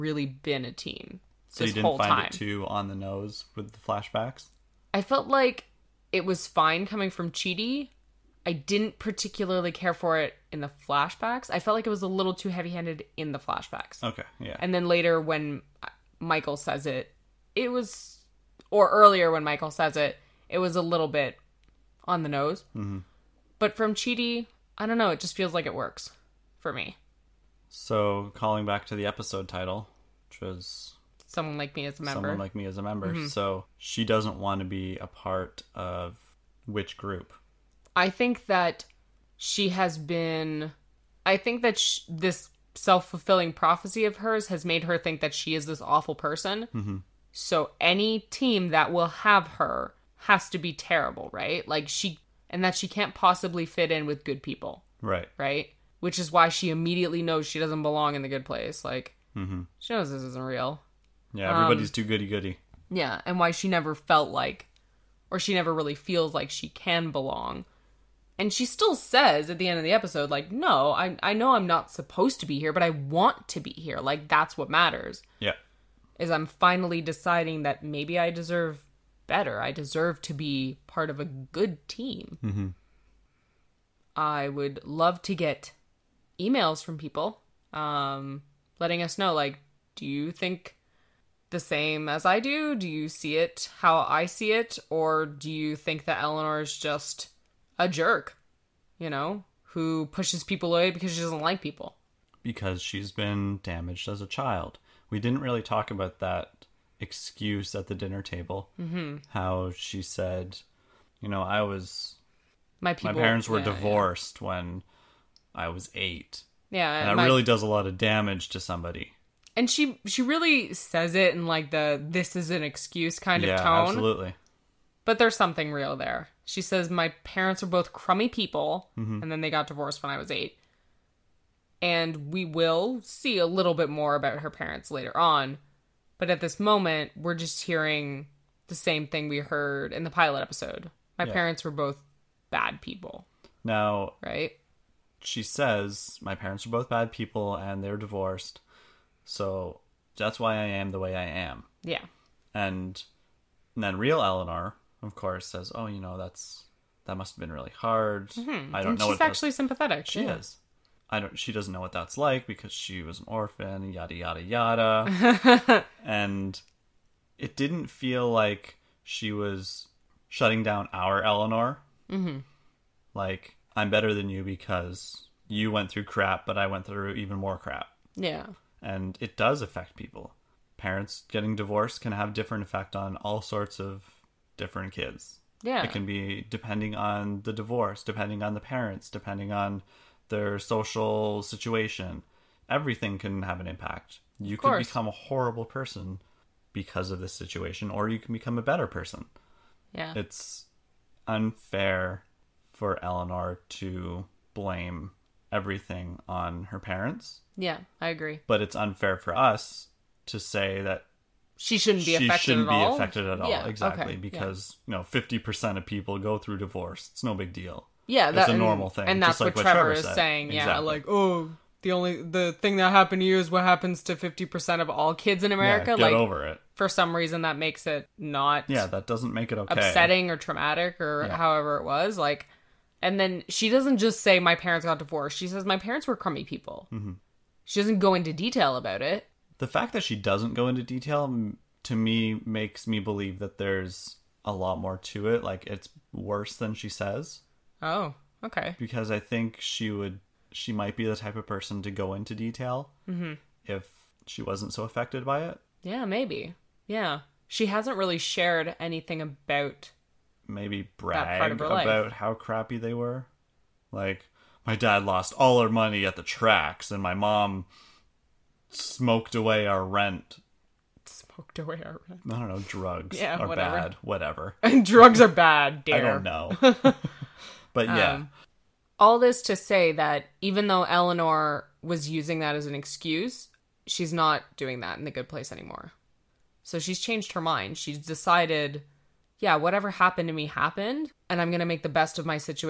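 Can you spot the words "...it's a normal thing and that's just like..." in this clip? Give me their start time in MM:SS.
03:38.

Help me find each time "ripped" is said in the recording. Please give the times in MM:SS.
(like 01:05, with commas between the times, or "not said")
not said.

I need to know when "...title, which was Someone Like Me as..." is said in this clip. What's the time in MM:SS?
00:29.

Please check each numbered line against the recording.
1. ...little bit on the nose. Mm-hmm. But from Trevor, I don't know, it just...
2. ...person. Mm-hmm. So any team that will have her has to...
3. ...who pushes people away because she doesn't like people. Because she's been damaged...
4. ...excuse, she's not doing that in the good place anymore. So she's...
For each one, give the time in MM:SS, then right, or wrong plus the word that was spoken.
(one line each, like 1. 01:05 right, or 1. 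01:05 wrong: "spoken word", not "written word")
1. 00:20 wrong: "Chidi", not "Trevor"
2. 00:46 right
3. 01:39 right
4. 04:42 right.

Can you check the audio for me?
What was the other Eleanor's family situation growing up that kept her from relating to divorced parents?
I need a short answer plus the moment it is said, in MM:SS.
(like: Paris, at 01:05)
orphan, at 02:43.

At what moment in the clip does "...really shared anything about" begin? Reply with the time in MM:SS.
04:17.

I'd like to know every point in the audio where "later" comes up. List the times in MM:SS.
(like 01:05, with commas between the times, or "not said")
00:14, 02:14.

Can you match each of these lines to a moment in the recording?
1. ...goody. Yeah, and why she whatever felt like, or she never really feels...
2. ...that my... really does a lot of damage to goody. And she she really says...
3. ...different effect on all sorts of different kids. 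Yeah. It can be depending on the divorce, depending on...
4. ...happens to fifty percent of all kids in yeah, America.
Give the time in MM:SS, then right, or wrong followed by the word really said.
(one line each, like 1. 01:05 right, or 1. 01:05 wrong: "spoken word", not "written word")
1. 01:02 wrong: "never", not "whatever"
2. 01:57 wrong: "somebody", not "goody"
3. 03:02 right
4. 03:43 right.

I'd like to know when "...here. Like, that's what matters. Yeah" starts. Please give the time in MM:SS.
01:13.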